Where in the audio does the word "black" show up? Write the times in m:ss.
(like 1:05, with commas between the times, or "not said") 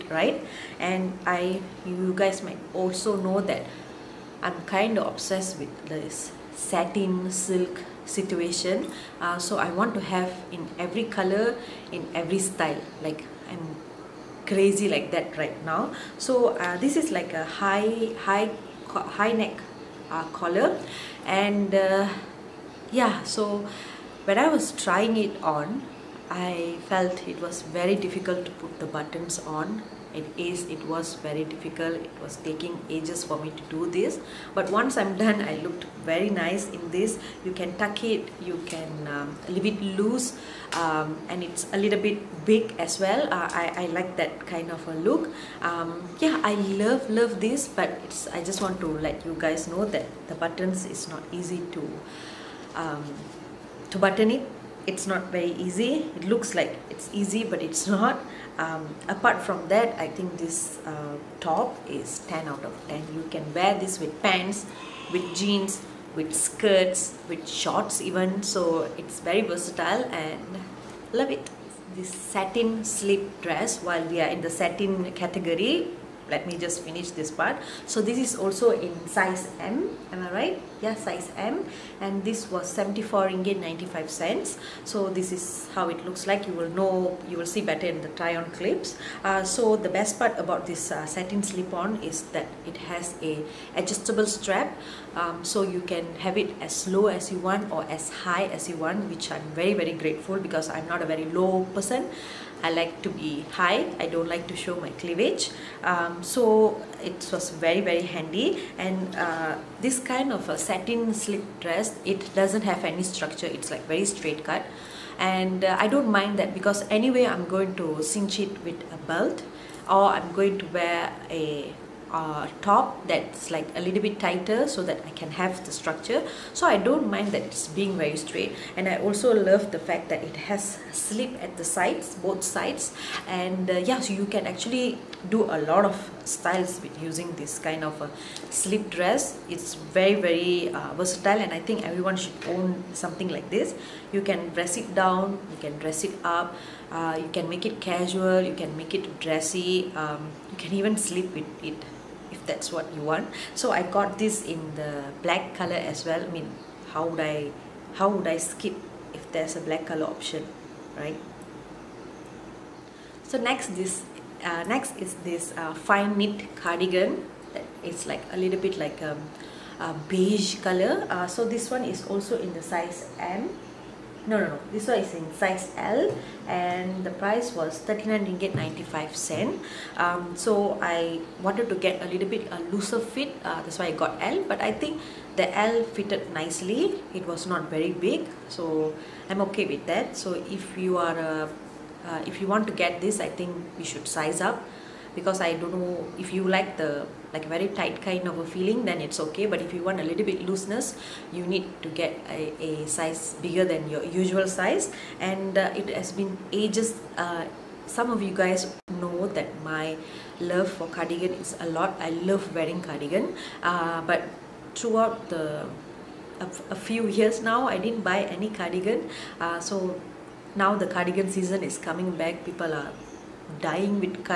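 2:35, 2:39.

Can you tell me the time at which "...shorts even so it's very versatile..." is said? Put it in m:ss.
1:07.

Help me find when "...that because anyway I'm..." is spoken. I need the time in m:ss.
1:56.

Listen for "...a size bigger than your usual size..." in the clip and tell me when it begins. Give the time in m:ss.
3:22.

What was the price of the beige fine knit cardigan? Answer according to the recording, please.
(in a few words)
39 ringgit 95 cents.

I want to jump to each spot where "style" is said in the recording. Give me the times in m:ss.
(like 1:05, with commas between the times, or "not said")
0:12, 2:16.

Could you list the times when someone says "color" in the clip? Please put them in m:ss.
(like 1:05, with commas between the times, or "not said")
0:11, 2:35, 2:39, 2:50.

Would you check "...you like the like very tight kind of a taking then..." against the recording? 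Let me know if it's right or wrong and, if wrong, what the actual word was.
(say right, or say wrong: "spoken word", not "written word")
wrong: "feeling", not "taking".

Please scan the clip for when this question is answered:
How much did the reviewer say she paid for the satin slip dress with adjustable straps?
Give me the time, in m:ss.
1:22.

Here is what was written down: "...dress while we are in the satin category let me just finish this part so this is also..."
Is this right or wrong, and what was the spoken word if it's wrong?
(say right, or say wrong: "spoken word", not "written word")
right.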